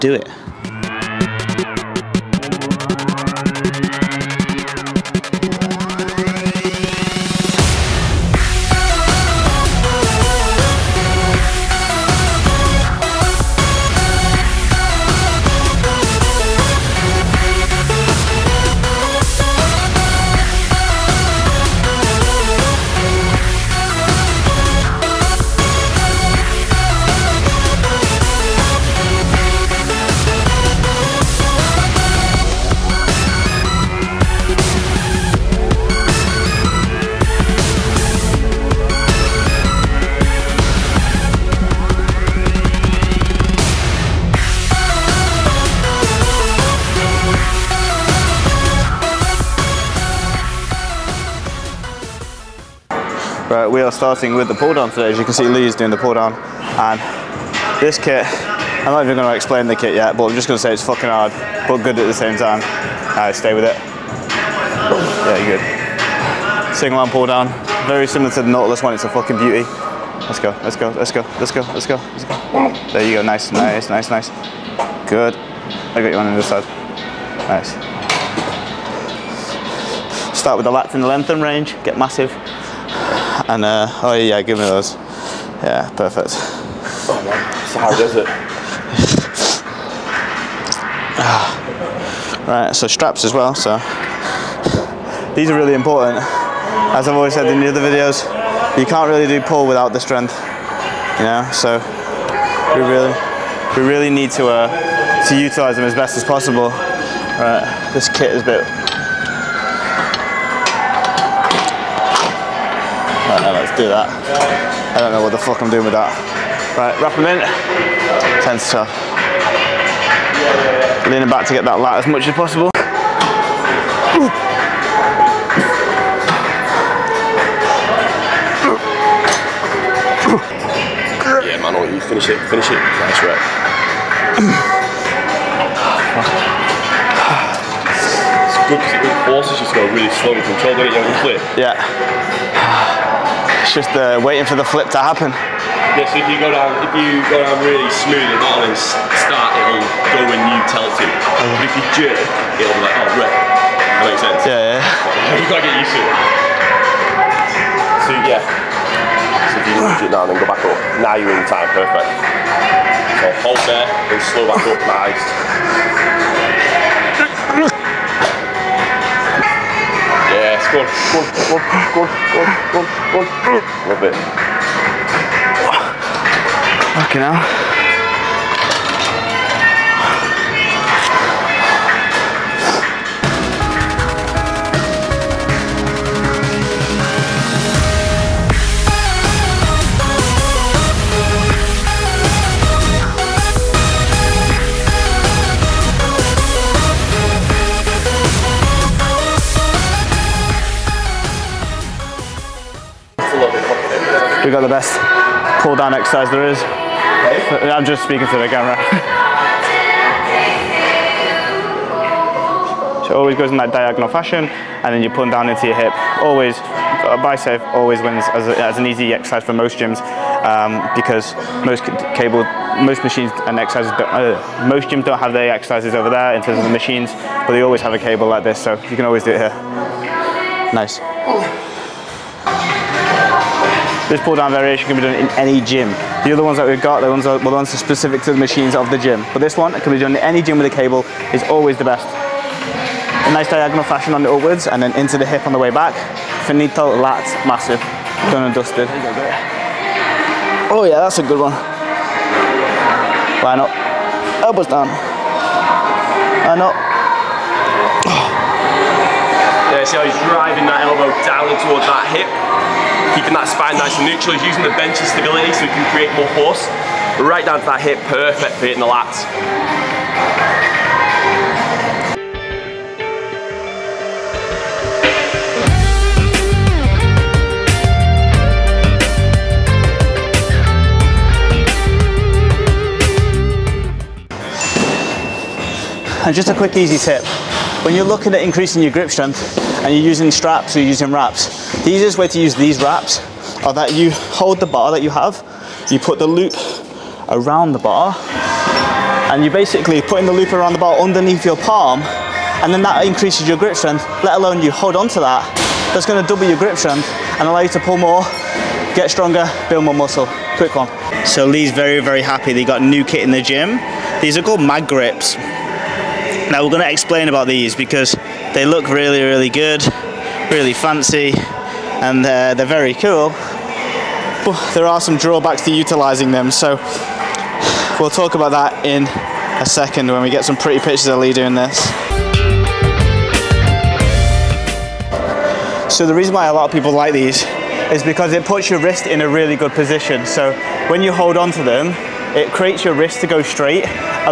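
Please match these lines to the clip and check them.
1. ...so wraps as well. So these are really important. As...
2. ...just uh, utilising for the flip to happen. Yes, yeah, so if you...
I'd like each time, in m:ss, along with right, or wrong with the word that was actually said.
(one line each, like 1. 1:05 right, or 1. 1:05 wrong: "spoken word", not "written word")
1. 1:32 wrong: "straps", not "wraps"
2. 2:23 wrong: "waiting", not "utilising".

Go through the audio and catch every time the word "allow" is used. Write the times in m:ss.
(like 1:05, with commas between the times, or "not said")
5:07.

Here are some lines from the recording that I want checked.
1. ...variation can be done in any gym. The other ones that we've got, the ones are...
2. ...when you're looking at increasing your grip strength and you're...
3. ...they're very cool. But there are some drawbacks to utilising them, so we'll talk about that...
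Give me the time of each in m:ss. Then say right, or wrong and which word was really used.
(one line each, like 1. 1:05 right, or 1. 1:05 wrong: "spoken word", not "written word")
1. 3:54 right
2. 4:47 right
3. 5:22 right.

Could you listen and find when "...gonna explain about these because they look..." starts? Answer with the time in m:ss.
5:16.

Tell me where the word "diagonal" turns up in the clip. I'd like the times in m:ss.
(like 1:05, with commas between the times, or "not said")
3:33, 4:03.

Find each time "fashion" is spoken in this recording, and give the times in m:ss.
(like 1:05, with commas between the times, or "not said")
3:34, 4:03.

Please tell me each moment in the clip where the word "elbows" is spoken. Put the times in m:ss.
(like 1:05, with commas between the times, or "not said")
4:14, 4:20.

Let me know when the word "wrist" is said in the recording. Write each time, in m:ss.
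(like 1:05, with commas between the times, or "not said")
5:38, 5:42.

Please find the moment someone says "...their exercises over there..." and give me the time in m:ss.
3:45.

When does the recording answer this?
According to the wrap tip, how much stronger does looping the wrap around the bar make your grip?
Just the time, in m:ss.
5:06.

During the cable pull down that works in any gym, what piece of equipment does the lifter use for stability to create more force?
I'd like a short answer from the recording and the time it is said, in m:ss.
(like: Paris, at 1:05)
The bench, at 4:24.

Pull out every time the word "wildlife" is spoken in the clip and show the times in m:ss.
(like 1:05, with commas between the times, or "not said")
not said.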